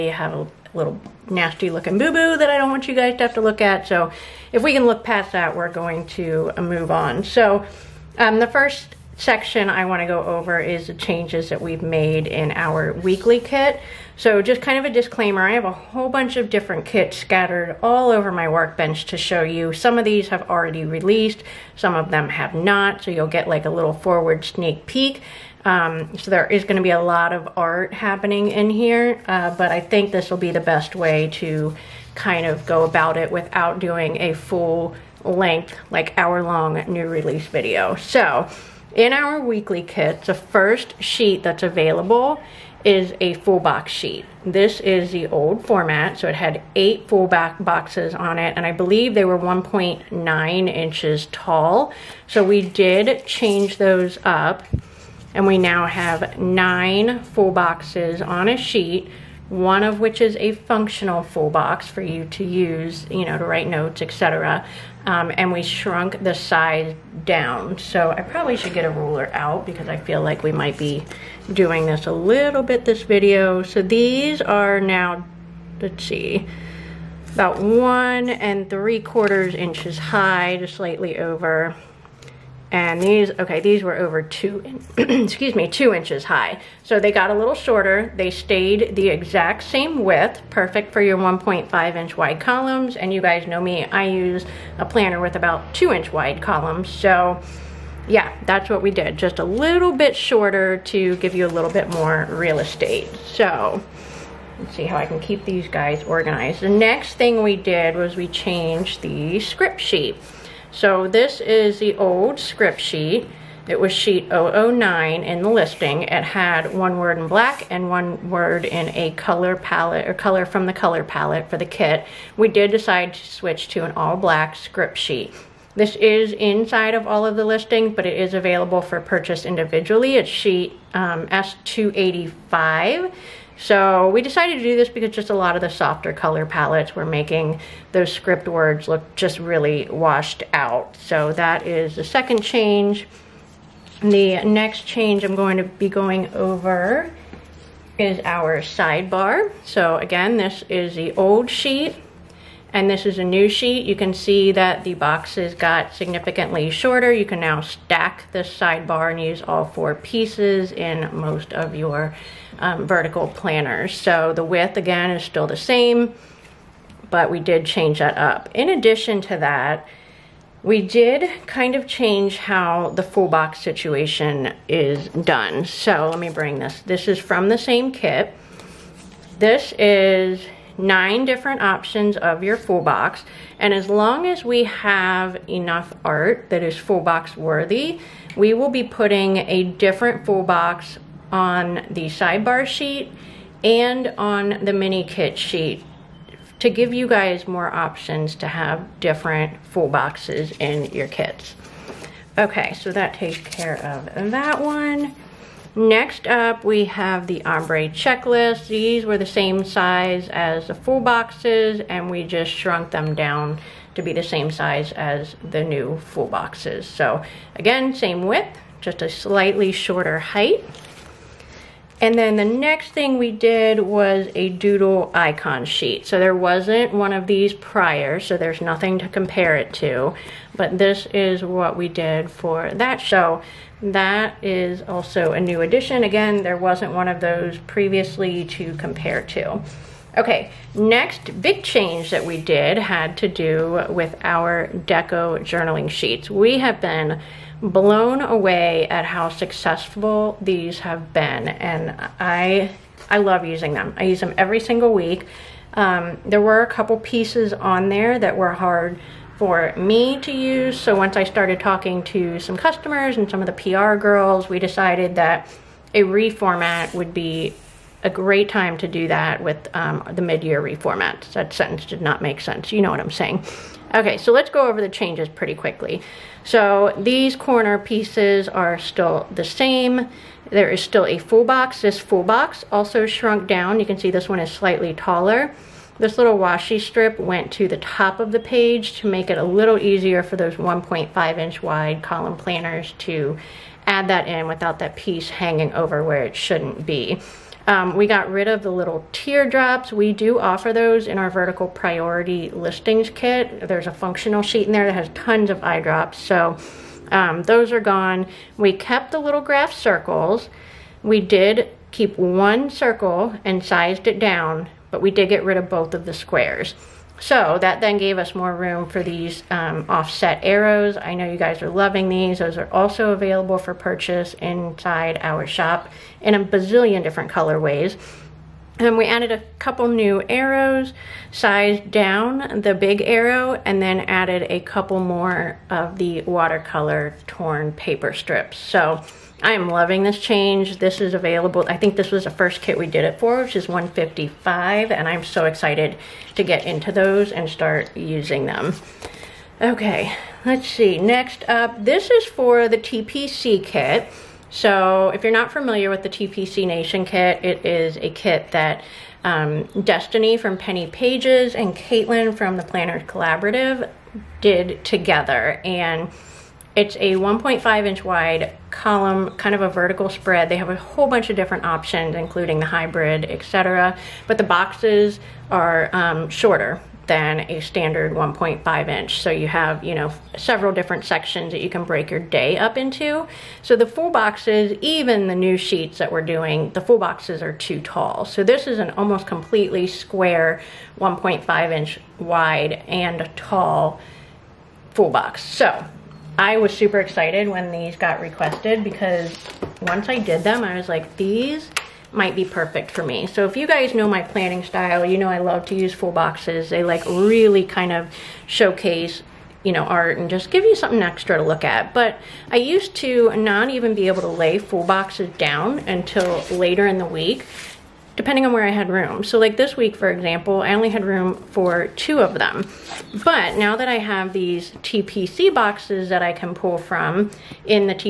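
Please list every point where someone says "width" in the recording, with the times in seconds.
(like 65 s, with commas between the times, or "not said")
90 s, 164 s, 218 s.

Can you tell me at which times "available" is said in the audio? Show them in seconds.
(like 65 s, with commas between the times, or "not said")
41 s, 128 s, 323 s, 341 s.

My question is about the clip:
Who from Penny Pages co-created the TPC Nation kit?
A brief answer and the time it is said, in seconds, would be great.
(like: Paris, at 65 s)
Destiny, at 359 s.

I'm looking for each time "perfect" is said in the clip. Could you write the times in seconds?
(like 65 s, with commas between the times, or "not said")
90 s, 402 s.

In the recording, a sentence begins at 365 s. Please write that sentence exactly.
And it's a 1.5 inch wide column, kind of a vertical spread.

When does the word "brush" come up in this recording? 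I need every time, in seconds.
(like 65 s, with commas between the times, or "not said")
not said.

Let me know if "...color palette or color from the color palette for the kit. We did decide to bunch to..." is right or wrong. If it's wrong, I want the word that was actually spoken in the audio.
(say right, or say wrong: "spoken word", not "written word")
wrong: "switch", not "bunch".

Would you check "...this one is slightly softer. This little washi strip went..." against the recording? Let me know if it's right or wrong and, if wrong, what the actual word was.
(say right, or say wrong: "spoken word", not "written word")
wrong: "taller", not "softer".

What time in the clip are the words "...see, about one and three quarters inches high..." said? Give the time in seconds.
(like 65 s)
76 s.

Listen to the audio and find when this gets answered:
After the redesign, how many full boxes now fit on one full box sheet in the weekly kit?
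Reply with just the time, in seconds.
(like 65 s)
56 s.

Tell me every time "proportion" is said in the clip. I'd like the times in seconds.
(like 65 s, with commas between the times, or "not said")
not said.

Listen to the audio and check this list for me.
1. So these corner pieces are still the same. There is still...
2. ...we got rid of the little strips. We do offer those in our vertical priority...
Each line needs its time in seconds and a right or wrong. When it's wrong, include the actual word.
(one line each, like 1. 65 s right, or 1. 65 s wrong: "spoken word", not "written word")
1. 276 s right
2. 297 s wrong: "teardrops", not "strips".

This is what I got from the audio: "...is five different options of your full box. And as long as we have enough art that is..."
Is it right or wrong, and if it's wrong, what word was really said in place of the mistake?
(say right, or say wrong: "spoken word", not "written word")
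wrong: "nine", not "five".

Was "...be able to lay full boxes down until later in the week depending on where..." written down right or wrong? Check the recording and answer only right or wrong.
right.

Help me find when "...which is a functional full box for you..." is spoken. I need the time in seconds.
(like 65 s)
59 s.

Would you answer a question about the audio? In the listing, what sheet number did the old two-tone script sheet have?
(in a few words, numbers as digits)
009.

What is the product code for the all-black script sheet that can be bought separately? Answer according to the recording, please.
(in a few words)
S285.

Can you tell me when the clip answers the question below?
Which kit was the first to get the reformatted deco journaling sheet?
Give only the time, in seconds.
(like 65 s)
343 s.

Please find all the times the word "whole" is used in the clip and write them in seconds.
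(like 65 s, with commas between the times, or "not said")
15 s, 370 s.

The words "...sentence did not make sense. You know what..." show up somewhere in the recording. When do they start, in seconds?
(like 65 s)
271 s.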